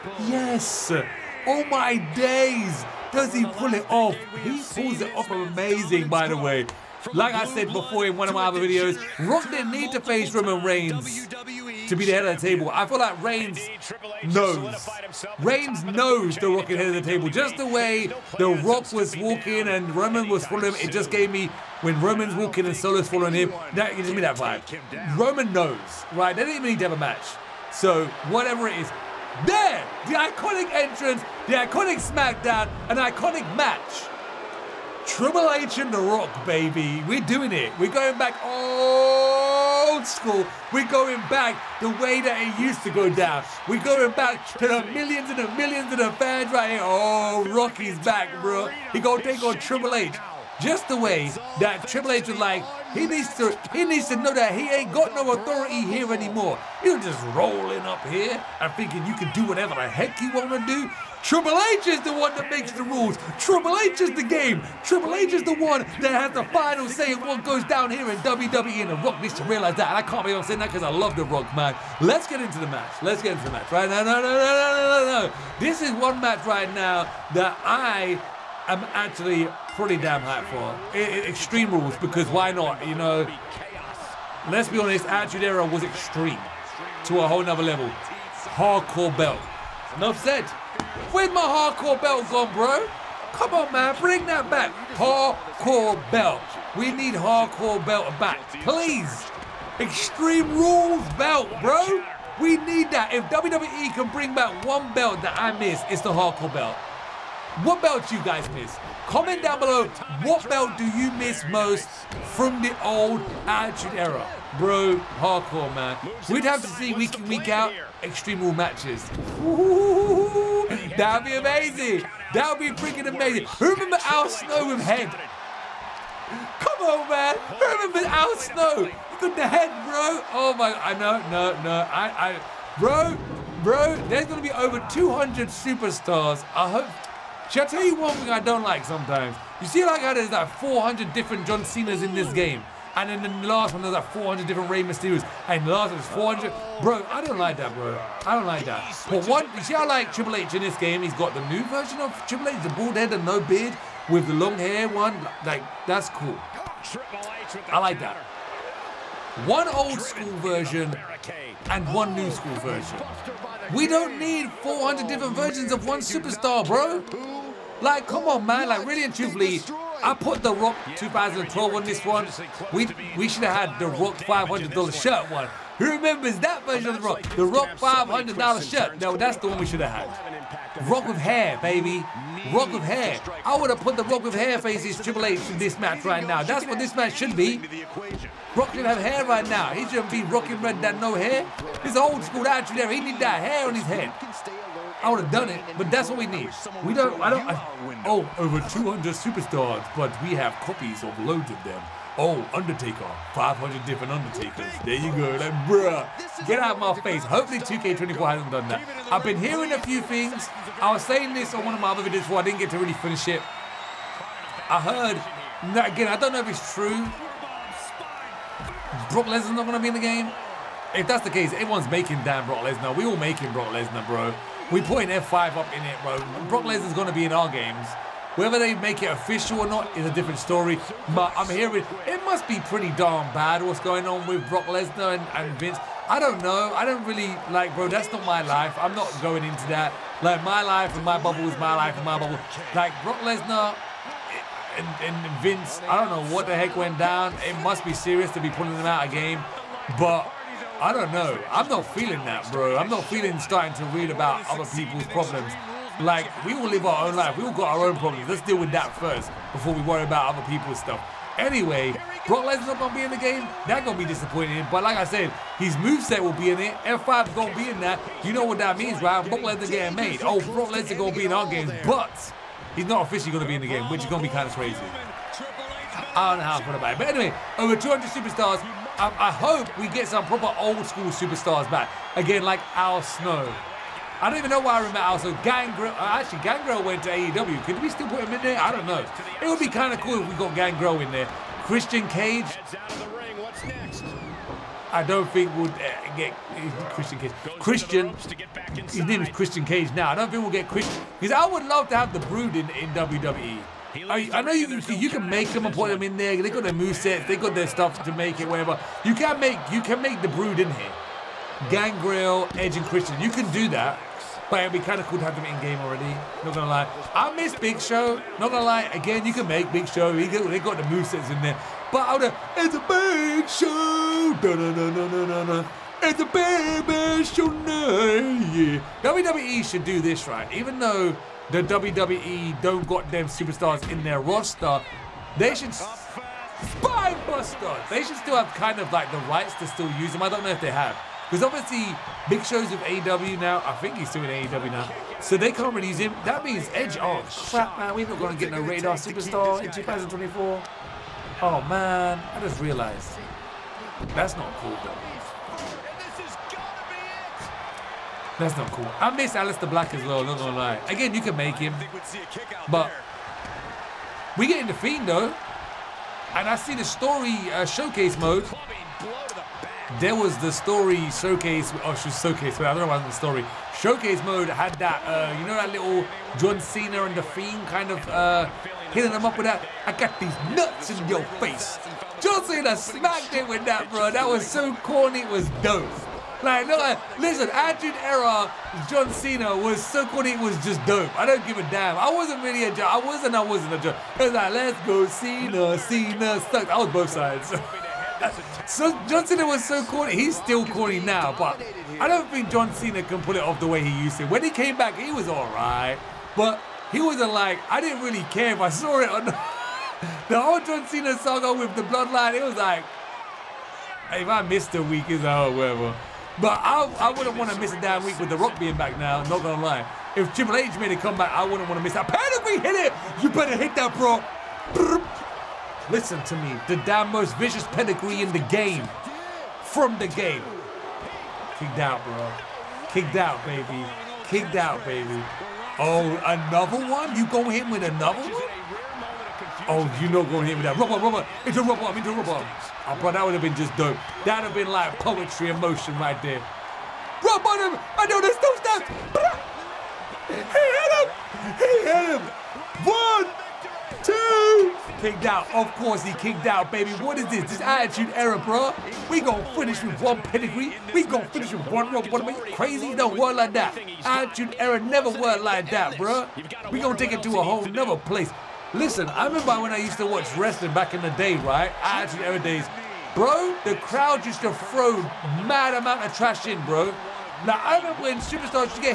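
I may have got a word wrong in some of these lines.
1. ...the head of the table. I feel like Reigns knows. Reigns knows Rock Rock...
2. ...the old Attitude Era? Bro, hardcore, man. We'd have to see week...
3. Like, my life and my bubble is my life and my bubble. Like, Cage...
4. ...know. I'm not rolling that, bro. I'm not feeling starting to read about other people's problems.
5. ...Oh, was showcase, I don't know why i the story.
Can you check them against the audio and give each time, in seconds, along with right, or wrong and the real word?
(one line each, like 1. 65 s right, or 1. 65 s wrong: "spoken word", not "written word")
1. 12 s wrong: "The", not "Rock"
2. 112 s right
3. 240 s wrong: "Brock", not "Cage"
4. 251 s wrong: "feeling", not "rolling"
5. 371 s right.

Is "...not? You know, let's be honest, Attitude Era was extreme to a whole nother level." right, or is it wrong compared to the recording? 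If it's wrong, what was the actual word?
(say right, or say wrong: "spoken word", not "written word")
right.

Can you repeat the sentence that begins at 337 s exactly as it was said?
They should still have kind of like the rights to still use them.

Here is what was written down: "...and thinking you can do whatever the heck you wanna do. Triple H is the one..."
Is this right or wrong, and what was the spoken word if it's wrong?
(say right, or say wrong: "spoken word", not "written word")
right.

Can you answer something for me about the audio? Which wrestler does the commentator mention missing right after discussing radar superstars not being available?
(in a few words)
Aleister Black.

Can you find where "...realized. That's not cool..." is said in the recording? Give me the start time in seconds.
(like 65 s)
352 s.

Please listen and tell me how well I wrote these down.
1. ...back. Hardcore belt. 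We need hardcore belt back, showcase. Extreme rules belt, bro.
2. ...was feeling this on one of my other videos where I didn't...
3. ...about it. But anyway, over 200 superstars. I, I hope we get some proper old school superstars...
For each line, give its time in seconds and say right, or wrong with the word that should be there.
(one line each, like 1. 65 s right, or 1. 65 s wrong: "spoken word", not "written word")
1. 94 s wrong: "please", not "showcase"
2. 210 s wrong: "saying", not "feeling"
3. 276 s right.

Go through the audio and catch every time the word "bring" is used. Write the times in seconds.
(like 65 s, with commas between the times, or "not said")
94 s, 104 s.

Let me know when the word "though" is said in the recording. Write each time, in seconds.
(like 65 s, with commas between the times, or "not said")
330 s, 354 s, 365 s.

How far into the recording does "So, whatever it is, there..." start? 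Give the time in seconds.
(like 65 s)
27 s.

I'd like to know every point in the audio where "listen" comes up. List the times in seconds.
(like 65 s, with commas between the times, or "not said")
387 s, 425 s, 468 s.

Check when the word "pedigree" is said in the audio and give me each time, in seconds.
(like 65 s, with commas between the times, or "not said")
422 s, 427 s, 460 s.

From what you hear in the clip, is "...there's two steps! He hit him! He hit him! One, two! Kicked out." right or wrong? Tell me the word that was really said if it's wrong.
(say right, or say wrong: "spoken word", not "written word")
right.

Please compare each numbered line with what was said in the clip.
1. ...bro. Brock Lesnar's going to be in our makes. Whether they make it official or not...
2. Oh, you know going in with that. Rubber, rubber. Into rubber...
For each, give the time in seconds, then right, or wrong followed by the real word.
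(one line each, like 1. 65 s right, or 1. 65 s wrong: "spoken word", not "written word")
1. 226 s wrong: "games", not "makes"
2. 439 s right.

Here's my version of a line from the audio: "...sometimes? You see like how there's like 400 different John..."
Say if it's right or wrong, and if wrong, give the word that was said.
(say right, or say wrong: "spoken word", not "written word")
right.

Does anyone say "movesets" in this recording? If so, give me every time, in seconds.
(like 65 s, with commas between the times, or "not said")
265 s, 306 s, 320 s.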